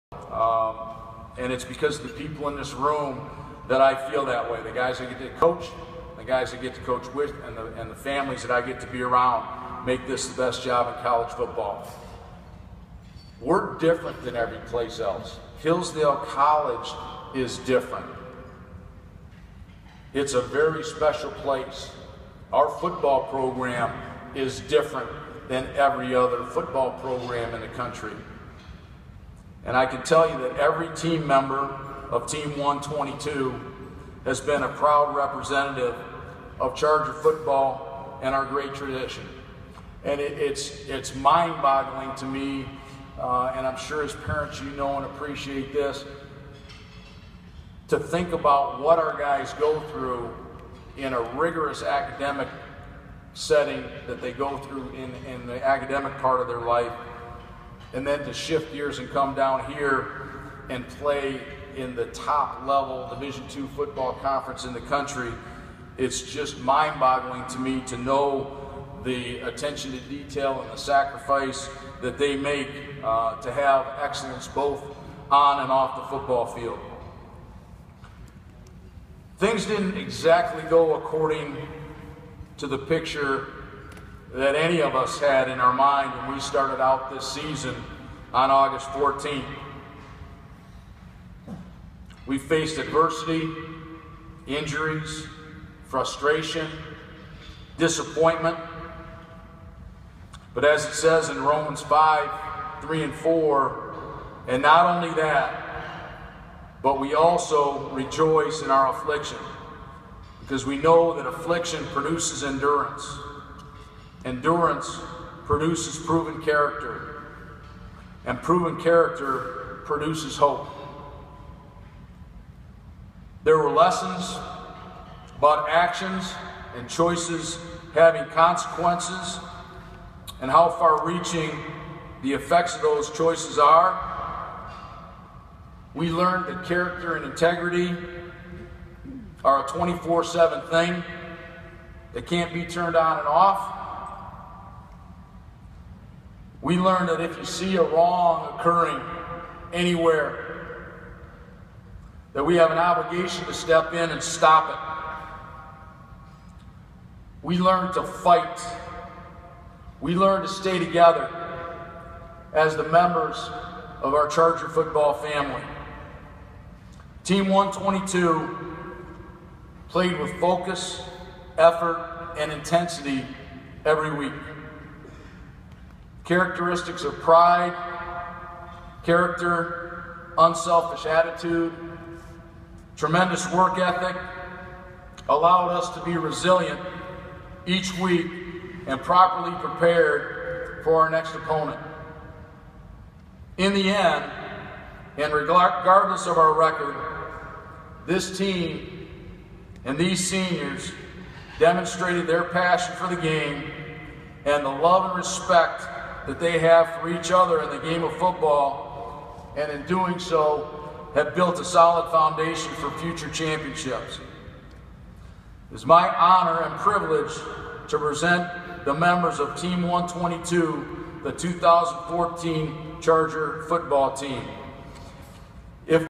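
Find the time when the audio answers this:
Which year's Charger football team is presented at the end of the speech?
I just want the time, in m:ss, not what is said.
3:41.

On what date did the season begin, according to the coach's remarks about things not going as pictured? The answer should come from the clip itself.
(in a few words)
August 14.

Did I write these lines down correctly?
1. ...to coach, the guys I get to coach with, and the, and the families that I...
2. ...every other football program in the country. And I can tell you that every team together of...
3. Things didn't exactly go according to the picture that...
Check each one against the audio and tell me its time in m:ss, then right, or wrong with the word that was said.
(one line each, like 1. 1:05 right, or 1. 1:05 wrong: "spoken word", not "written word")
1. 0:05 right
2. 0:25 wrong: "member", not "together"
3. 1:19 right.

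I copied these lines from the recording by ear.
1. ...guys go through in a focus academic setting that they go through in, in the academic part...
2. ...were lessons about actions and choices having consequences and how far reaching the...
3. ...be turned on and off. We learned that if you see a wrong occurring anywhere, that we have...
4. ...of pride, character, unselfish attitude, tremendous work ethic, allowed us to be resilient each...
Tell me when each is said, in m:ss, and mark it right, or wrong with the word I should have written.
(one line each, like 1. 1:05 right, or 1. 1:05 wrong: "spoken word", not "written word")
1. 0:49 wrong: "rigorous", not "focus"
2. 2:03 right
3. 2:22 right
4. 2:57 right.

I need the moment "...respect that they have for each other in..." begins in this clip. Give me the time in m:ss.
3:25.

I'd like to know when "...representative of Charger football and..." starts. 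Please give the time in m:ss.
0:35.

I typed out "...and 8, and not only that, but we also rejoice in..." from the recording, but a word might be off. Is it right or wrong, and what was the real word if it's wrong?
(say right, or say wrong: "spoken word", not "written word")
wrong: "4", not "8".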